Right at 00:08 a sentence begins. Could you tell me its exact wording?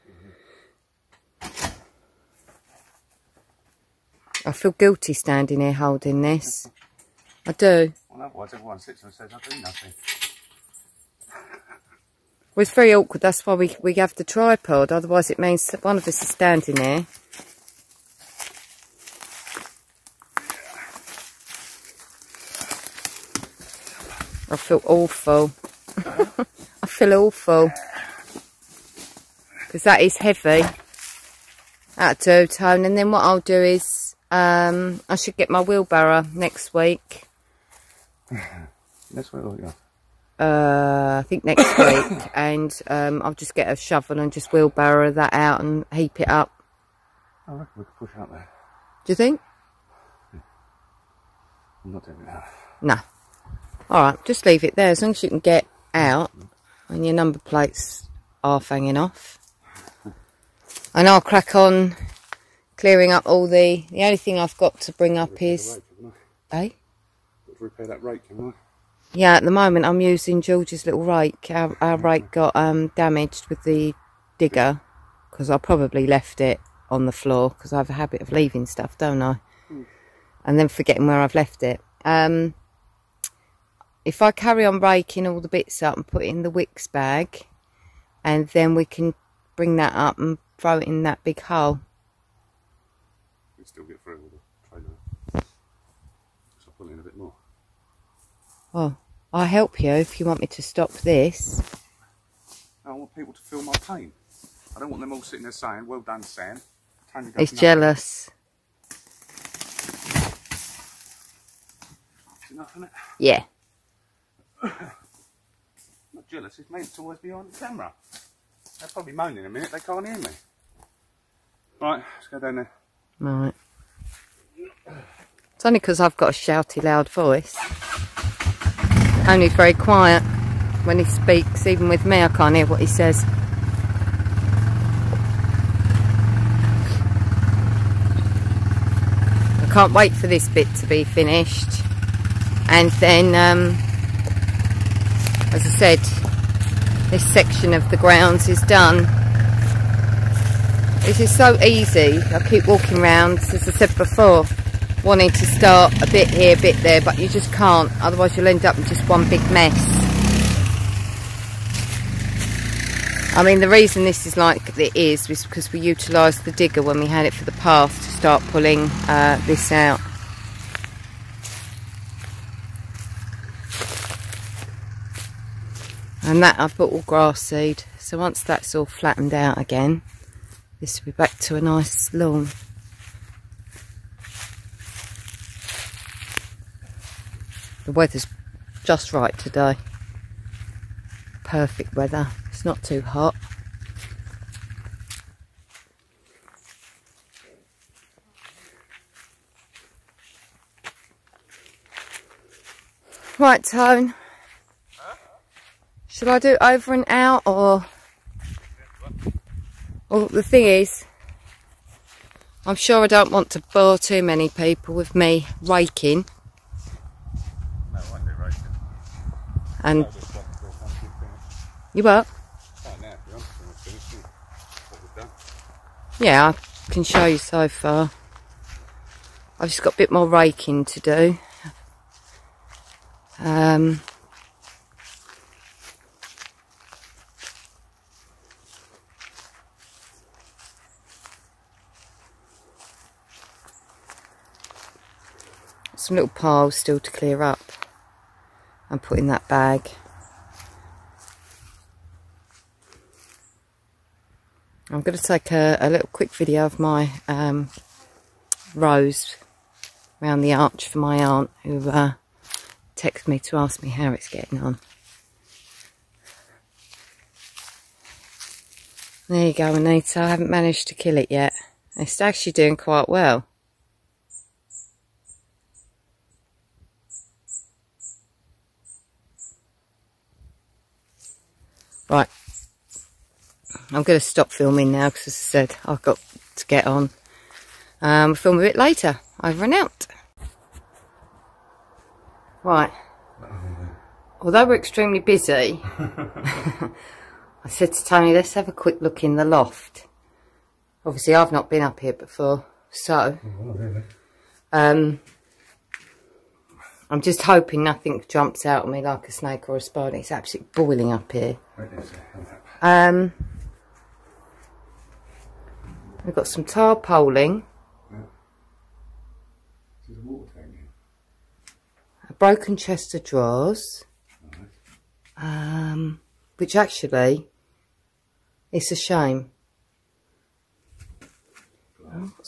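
Well, otherwise everyone sits and says I do nothing.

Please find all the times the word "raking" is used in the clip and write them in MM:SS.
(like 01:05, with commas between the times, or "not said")
01:24, 03:35, 03:50.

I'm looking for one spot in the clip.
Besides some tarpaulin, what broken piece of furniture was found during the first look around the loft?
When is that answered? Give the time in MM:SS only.
05:22.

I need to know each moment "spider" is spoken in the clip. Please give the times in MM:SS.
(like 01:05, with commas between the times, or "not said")
05:09.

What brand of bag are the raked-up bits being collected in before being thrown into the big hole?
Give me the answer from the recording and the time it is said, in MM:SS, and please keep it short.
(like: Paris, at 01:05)
Wickes, at 01:26.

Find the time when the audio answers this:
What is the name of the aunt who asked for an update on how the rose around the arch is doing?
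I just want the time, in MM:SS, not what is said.
04:29.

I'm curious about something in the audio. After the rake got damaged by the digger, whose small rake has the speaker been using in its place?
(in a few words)
George.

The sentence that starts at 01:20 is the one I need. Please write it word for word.
And then forgetting where I've left it.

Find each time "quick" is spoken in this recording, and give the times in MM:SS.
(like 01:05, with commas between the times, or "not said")
04:16, 04:58.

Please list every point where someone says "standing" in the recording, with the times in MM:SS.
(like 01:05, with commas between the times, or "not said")
00:05, 00:16.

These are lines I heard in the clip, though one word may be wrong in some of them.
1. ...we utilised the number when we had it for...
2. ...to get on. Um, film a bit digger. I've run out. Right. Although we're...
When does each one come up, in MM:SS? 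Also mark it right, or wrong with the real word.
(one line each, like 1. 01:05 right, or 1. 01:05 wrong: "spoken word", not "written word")
1. 02:45 wrong: "digger", not "number"
2. 04:46 wrong: "later", not "digger".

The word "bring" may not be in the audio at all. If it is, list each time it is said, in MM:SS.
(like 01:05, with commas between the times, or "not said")
01:04, 01:29.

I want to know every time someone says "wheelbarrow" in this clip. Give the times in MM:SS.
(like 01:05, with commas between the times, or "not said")
00:35, 00:44.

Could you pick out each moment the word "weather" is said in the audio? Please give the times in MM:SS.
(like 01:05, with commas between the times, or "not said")
03:07, 03:11.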